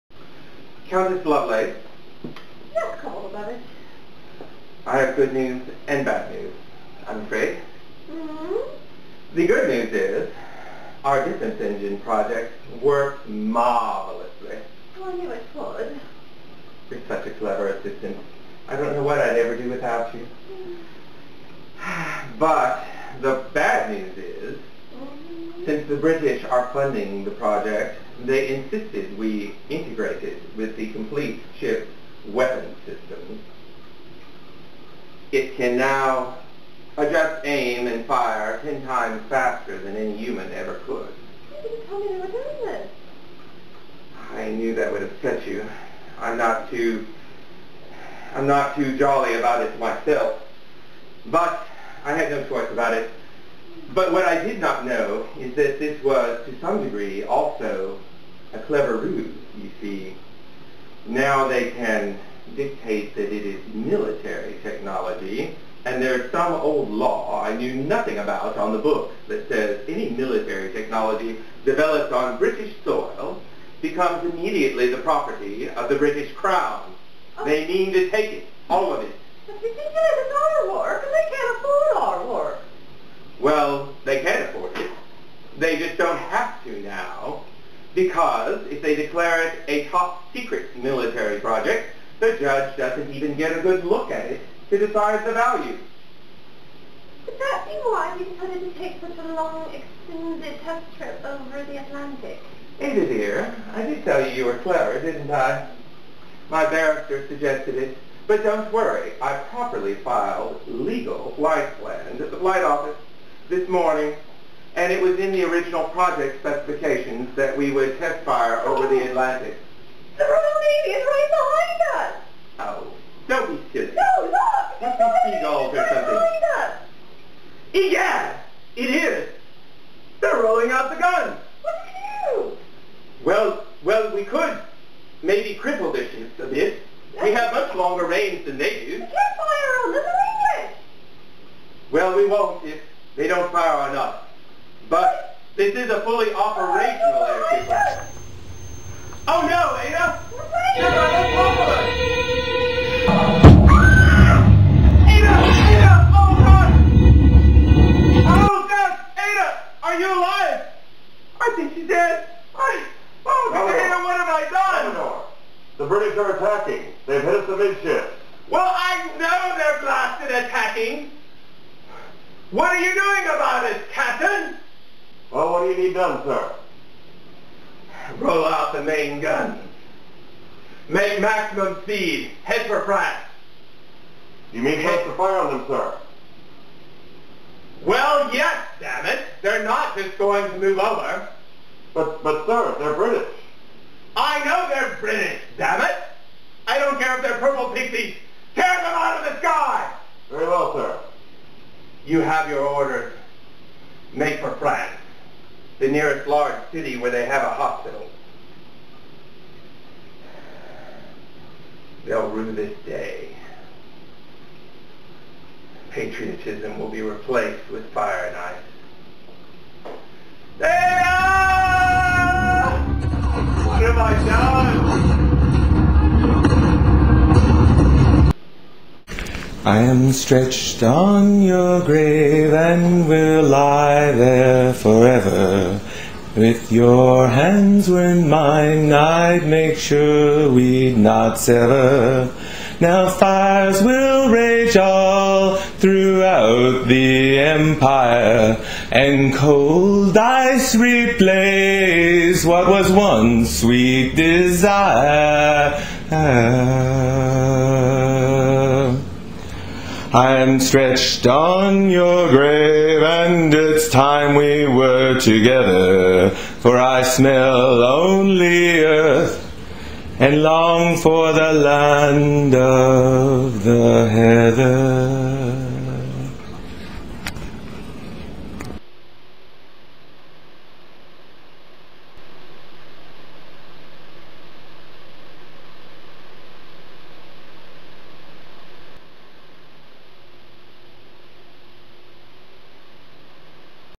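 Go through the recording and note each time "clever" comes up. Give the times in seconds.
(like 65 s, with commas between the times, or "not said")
17 s, 58 s, 104 s.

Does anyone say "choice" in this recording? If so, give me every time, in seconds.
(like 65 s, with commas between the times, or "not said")
52 s.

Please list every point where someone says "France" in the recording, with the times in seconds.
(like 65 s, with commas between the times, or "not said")
182 s, 204 s.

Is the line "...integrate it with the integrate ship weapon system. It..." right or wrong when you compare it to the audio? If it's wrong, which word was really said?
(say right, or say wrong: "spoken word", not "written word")
wrong: "complete", not "integrate".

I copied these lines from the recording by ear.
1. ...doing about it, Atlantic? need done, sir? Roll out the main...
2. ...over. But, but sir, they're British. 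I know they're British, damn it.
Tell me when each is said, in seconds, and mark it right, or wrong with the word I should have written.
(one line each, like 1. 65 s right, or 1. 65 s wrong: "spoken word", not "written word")
1. 172 s wrong: "Captain", not "Atlantic"
2. 190 s right.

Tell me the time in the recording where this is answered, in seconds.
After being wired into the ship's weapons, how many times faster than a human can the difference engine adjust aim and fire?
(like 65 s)
38 s.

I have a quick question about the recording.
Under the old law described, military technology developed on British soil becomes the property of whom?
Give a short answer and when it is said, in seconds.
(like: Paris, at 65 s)
The British Crown, at 75 s.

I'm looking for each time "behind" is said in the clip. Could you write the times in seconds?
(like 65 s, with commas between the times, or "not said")
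121 s, 126 s.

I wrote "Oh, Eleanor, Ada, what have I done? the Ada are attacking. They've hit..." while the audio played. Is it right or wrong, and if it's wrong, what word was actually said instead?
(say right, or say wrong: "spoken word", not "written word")
wrong: "British", not "Ada".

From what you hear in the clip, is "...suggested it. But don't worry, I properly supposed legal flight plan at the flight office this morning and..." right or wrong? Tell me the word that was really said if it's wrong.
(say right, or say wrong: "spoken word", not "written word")
wrong: "filed", not "supposed".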